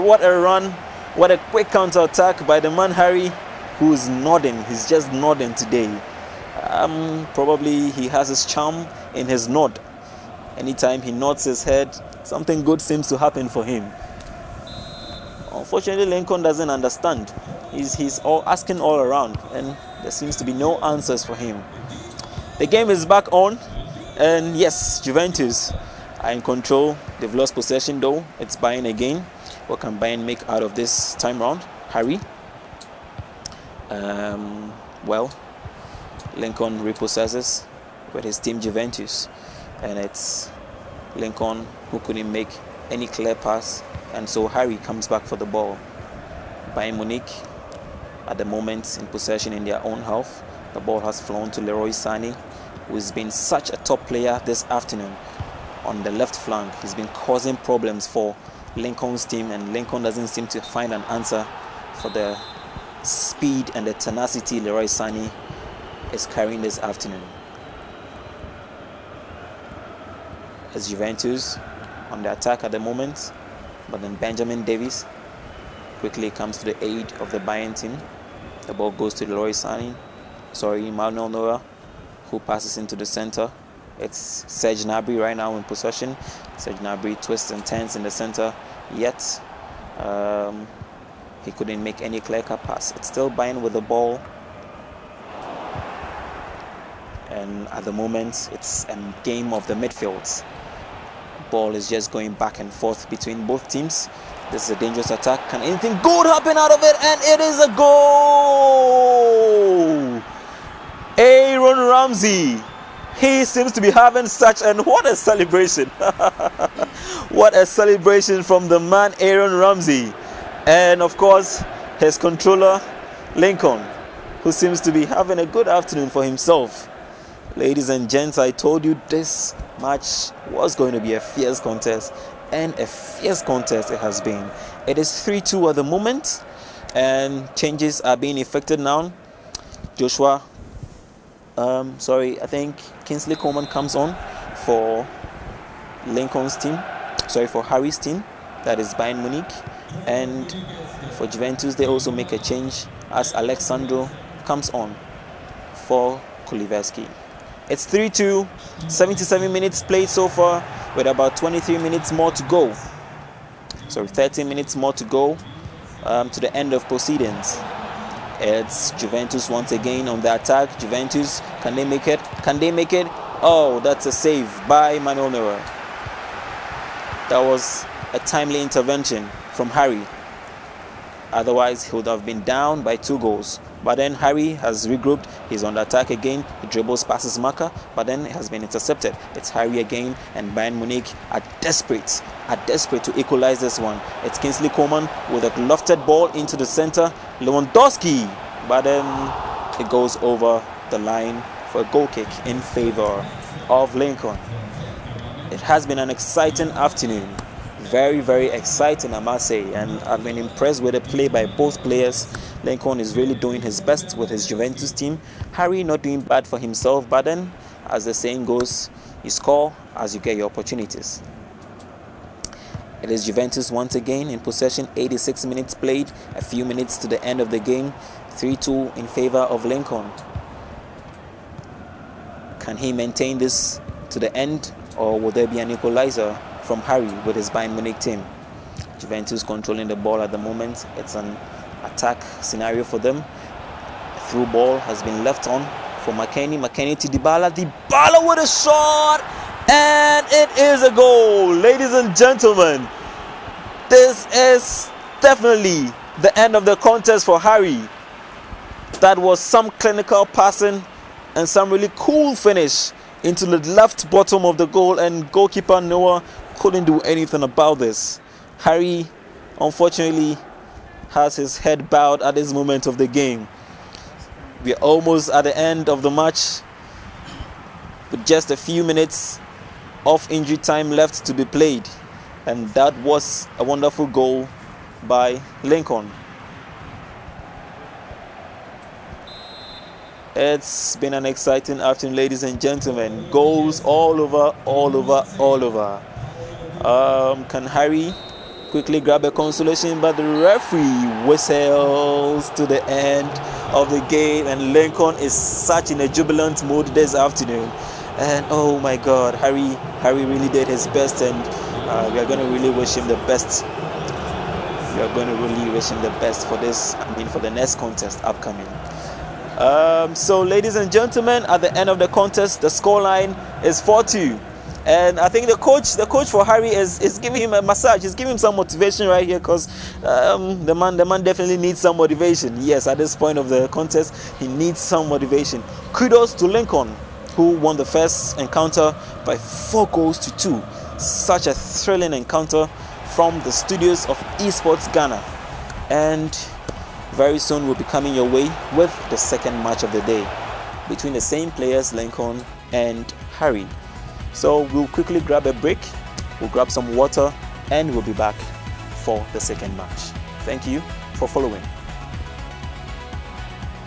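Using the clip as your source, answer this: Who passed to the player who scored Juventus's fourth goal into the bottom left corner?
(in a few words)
McKennie.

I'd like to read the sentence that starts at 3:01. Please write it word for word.
Otherwise, he would have been down by two goals.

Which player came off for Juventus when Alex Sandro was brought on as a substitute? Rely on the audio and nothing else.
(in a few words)
Kulusevski.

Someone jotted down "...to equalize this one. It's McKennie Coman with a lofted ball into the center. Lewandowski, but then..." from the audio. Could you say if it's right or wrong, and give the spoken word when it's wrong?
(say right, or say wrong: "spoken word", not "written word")
wrong: "Kingsley", not "McKennie".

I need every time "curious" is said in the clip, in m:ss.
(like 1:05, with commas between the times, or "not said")
not said.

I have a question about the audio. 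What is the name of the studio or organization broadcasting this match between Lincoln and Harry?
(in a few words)
Esports Ghana.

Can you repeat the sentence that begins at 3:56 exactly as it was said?
from Harry with his Bayern Munich team.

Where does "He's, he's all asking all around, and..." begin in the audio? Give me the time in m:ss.
0:17.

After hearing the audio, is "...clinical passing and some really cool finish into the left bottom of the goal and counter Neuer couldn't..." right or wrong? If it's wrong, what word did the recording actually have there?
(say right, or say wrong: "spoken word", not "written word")
wrong: "goalkeeper", not "counter".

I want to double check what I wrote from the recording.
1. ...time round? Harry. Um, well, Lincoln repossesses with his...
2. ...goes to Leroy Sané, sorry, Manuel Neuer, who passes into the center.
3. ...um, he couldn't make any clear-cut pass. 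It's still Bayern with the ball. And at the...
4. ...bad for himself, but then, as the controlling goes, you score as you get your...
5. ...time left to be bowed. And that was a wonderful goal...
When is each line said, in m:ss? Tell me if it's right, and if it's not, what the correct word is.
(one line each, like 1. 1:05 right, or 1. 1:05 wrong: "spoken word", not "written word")
1. 0:31 right
2. 1:18 right
3. 1:29 right
4. 3:36 wrong: "saying", not "controlling"
5. 4:40 wrong: "played", not "bowed".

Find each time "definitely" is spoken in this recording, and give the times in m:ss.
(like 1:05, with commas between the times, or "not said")
4:15, 5:31.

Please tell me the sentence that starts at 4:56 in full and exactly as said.
Um, can Harry quickly grab a consolation?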